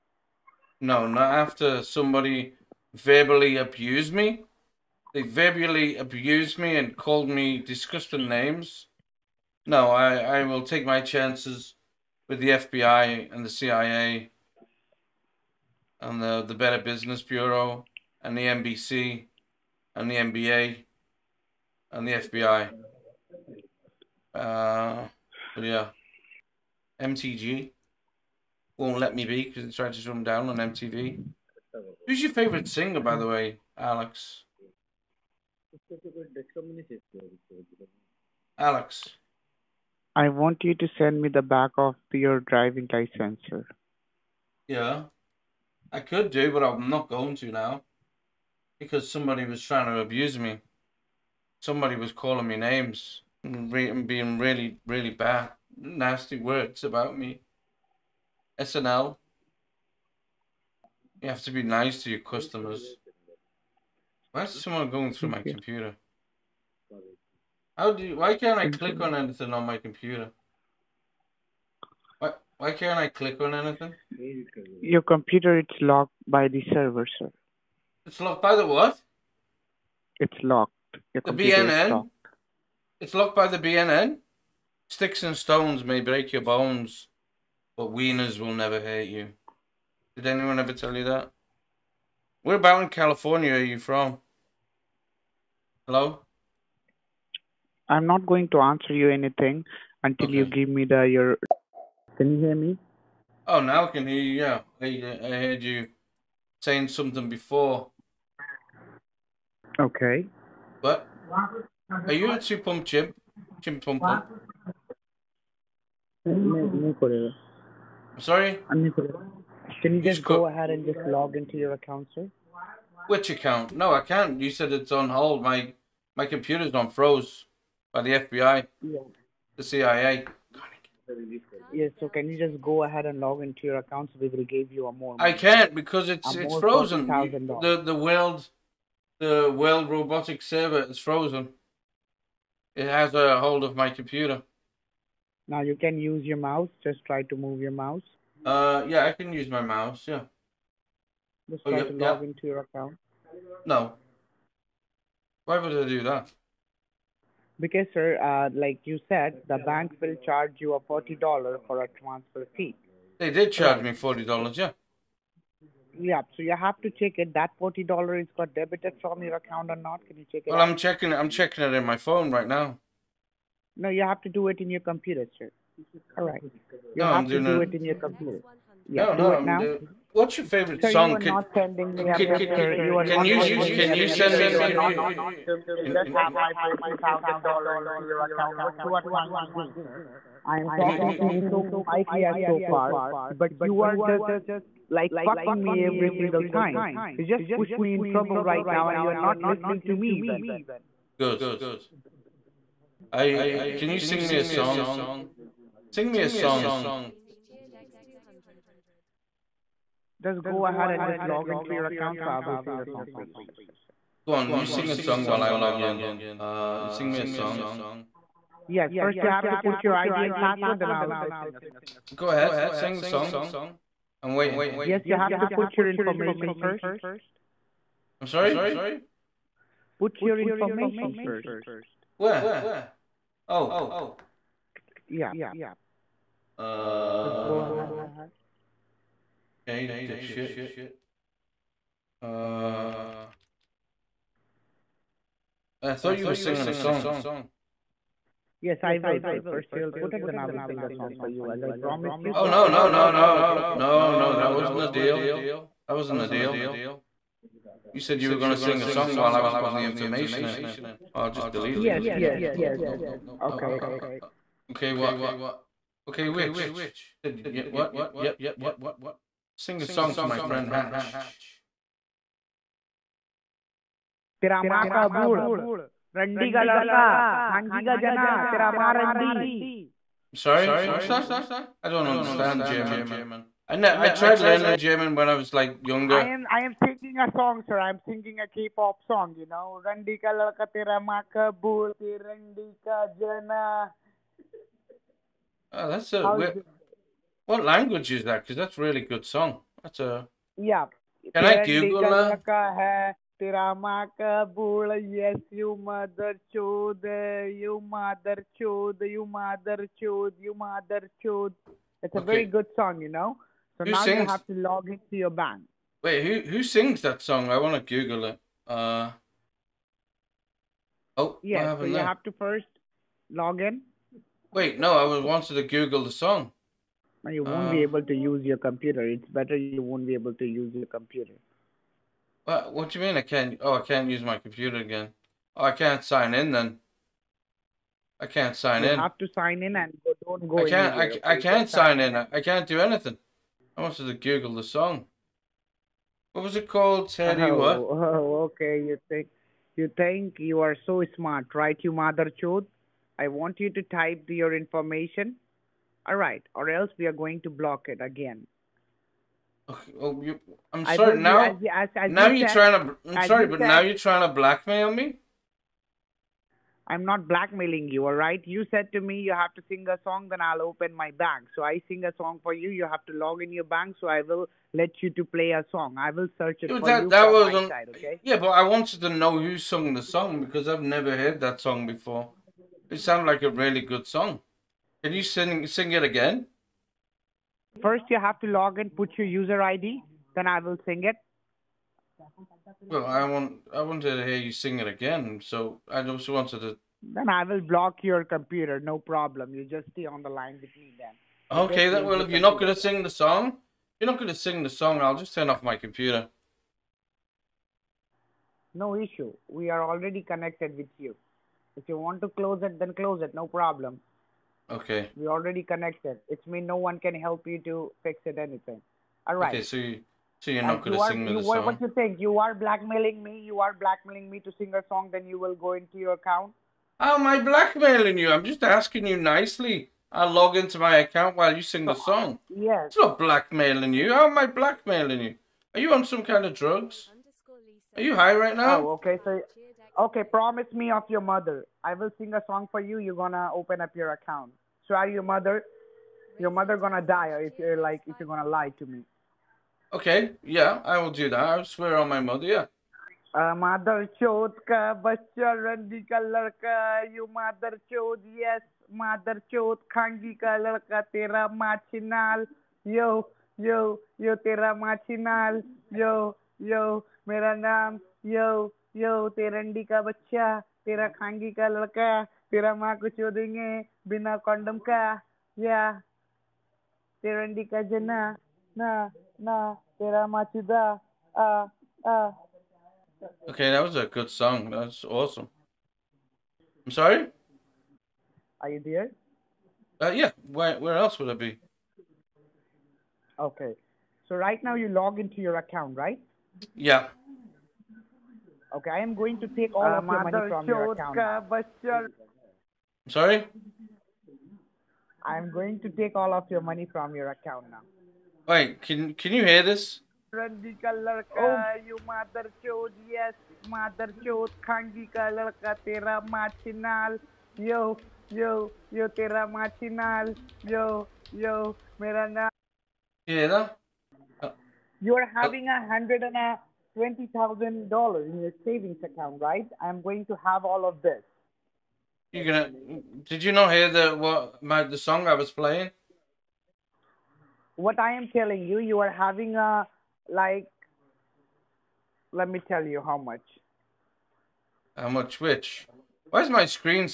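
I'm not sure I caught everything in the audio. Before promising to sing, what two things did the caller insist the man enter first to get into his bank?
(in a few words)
ID and password.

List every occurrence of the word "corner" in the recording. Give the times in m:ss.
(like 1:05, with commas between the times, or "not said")
not said.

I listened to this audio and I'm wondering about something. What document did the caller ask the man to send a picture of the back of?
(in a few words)
Driving license.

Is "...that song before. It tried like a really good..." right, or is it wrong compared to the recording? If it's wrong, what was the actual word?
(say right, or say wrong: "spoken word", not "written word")
wrong: "sounded", not "tried".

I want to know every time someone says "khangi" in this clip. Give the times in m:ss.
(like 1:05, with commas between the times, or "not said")
7:39, 7:51.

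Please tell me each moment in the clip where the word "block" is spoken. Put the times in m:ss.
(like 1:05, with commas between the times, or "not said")
5:57, 6:37.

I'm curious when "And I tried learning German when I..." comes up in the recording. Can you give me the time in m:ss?
4:43.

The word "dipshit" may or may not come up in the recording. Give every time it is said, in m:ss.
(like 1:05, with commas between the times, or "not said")
4:00.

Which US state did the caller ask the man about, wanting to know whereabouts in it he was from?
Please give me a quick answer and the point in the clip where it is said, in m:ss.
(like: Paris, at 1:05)
California, at 1:32.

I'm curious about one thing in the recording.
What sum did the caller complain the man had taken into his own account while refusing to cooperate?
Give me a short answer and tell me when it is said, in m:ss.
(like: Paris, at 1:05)
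$40,000, at 3:06.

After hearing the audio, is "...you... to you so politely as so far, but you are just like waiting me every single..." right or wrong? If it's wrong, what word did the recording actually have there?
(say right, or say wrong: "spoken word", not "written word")
wrong: "fucking", not "waiting".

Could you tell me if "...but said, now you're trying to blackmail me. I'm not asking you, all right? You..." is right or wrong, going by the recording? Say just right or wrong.
wrong.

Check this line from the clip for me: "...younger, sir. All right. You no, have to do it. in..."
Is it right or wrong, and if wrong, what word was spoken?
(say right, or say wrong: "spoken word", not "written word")
wrong: "computer", not "younger".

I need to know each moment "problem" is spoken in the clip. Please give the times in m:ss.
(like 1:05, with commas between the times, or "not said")
6:38, 6:53.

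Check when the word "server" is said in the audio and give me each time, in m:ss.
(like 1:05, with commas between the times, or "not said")
1:16, 2:20.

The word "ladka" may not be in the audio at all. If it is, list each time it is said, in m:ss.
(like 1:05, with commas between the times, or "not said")
7:36, 7:40, 7:51.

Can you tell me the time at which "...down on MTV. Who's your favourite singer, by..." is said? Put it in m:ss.
0:30.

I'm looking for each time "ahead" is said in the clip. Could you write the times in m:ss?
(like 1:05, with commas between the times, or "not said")
2:00, 2:12, 3:30, 3:42, 3:57.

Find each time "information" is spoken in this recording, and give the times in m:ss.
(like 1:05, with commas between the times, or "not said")
3:45, 3:50, 4:19, 5:54.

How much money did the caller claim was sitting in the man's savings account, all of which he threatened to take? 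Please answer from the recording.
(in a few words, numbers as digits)
$120,000.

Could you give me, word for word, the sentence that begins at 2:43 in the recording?
They did charge me forty dollars.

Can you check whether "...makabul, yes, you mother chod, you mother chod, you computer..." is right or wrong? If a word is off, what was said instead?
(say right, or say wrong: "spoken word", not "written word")
wrong: "mother", not "computer".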